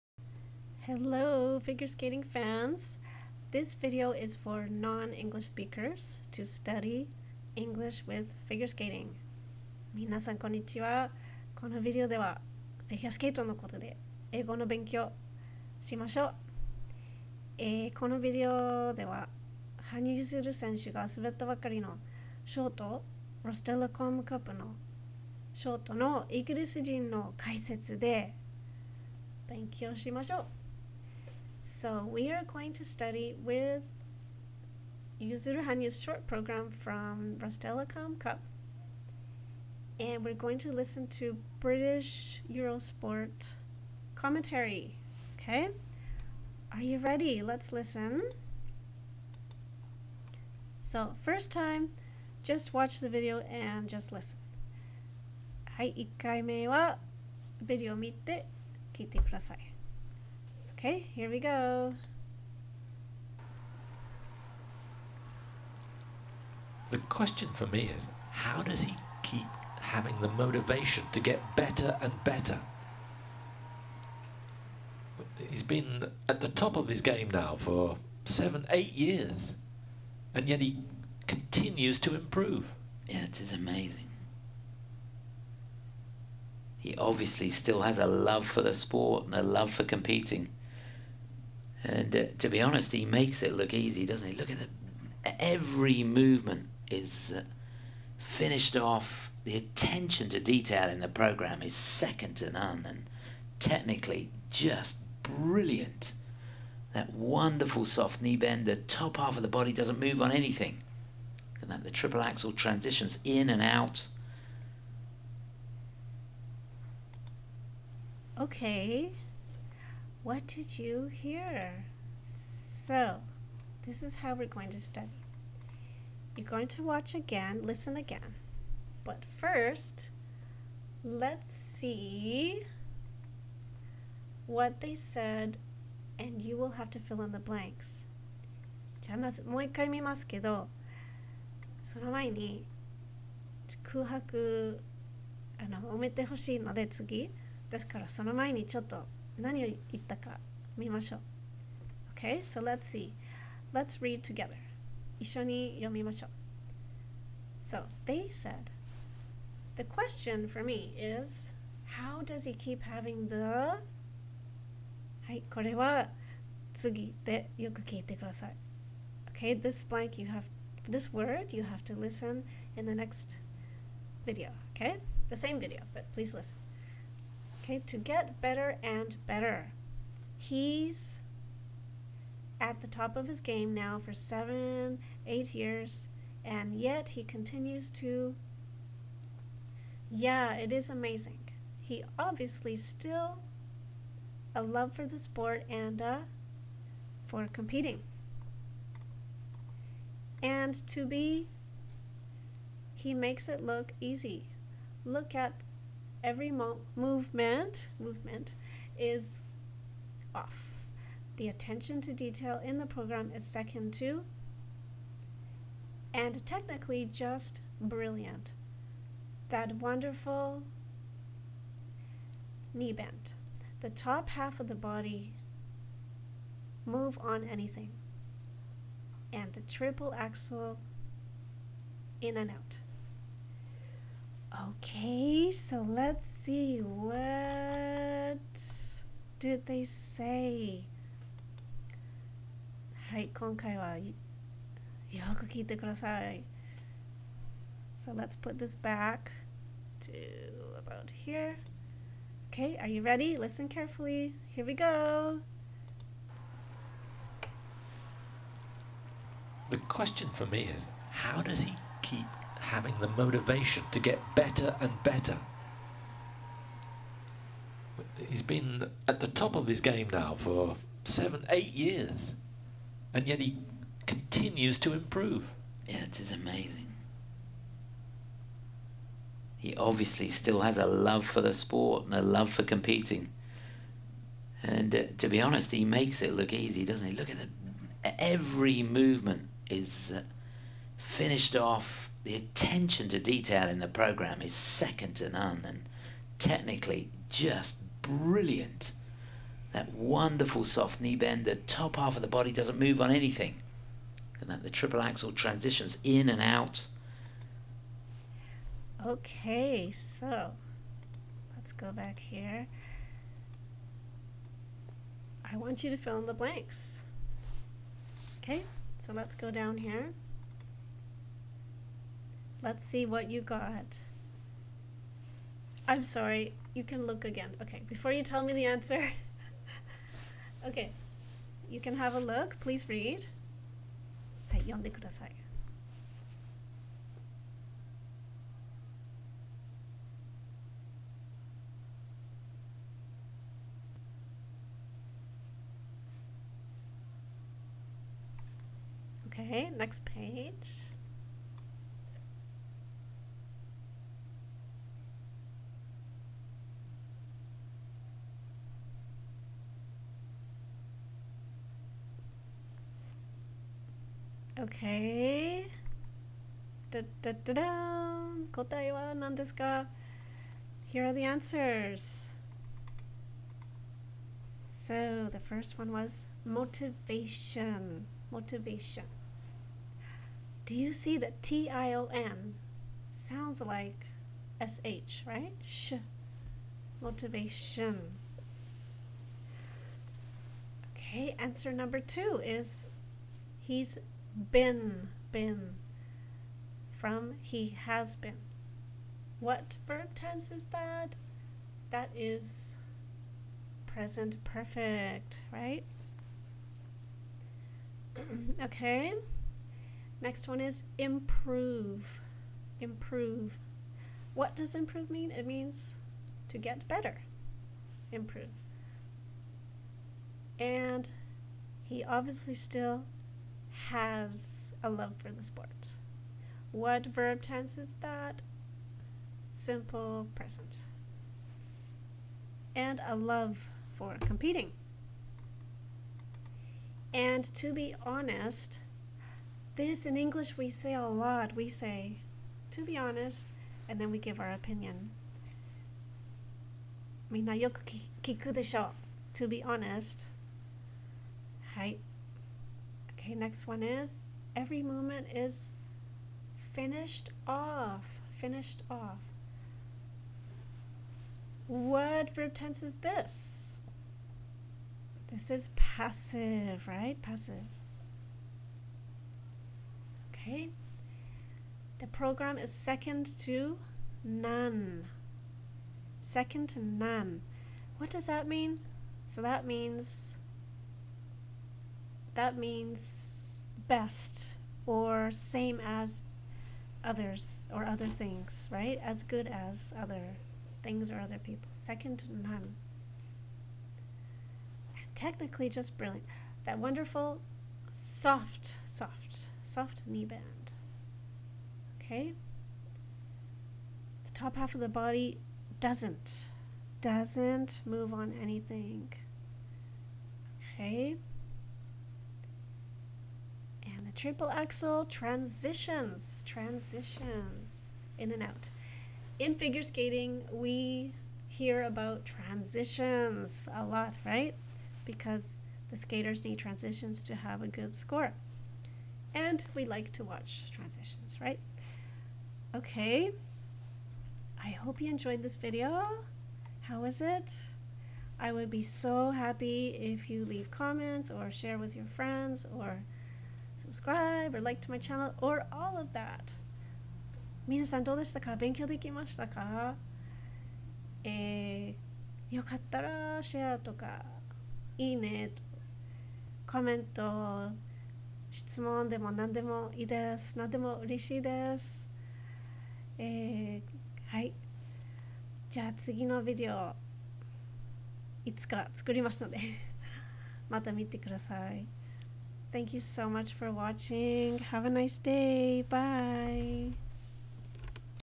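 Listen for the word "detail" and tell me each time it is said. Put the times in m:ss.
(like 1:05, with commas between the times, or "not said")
1:40, 3:32, 4:53.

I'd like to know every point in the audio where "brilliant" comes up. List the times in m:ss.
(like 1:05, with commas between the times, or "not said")
1:45, 3:37, 4:58, 8:15.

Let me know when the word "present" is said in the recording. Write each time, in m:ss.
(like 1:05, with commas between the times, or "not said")
6:43, 7:10.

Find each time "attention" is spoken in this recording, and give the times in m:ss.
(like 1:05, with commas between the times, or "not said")
1:39, 3:31, 4:52.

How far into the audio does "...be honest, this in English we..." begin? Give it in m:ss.
7:17.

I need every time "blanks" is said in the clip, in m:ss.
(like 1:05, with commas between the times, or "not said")
2:17, 2:49, 5:16.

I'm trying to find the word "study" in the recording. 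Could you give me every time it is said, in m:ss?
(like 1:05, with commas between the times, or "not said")
0:06, 0:32, 2:04.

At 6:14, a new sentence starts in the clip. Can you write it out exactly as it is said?
So the first one was motivation.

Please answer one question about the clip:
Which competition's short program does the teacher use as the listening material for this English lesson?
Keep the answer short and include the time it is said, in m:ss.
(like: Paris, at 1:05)
Rostelecom Cup, at 0:37.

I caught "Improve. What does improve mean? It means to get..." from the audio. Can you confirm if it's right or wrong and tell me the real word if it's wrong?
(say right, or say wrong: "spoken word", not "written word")
right.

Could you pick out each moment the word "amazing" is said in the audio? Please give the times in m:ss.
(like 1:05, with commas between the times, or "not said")
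1:23, 3:10, 4:36.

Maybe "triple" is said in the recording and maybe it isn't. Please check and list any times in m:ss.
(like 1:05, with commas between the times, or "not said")
1:51, 3:49, 5:04, 8:34.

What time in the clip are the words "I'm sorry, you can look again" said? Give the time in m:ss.
5:25.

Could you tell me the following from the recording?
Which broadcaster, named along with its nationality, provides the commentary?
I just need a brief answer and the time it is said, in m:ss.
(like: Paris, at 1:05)
British Eurosport, at 0:41.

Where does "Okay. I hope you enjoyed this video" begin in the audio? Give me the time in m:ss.
8:52.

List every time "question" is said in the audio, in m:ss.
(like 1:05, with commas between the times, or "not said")
1:06, 2:39, 4:19.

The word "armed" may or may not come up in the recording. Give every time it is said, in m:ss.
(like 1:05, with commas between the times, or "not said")
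not said.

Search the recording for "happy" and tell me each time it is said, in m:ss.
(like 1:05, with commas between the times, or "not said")
8:59.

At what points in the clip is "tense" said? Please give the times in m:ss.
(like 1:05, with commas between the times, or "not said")
6:40, 7:07, 7:42.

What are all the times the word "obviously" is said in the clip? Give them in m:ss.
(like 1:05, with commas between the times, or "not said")
1:26, 3:12, 4:39, 7:02.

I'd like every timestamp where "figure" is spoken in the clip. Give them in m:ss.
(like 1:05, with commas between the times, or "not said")
0:01, 0:08, 8:39.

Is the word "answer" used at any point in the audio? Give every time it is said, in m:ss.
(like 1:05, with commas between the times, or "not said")
5:28, 6:11, 6:31.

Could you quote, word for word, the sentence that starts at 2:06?
You're going to watch again, listen again.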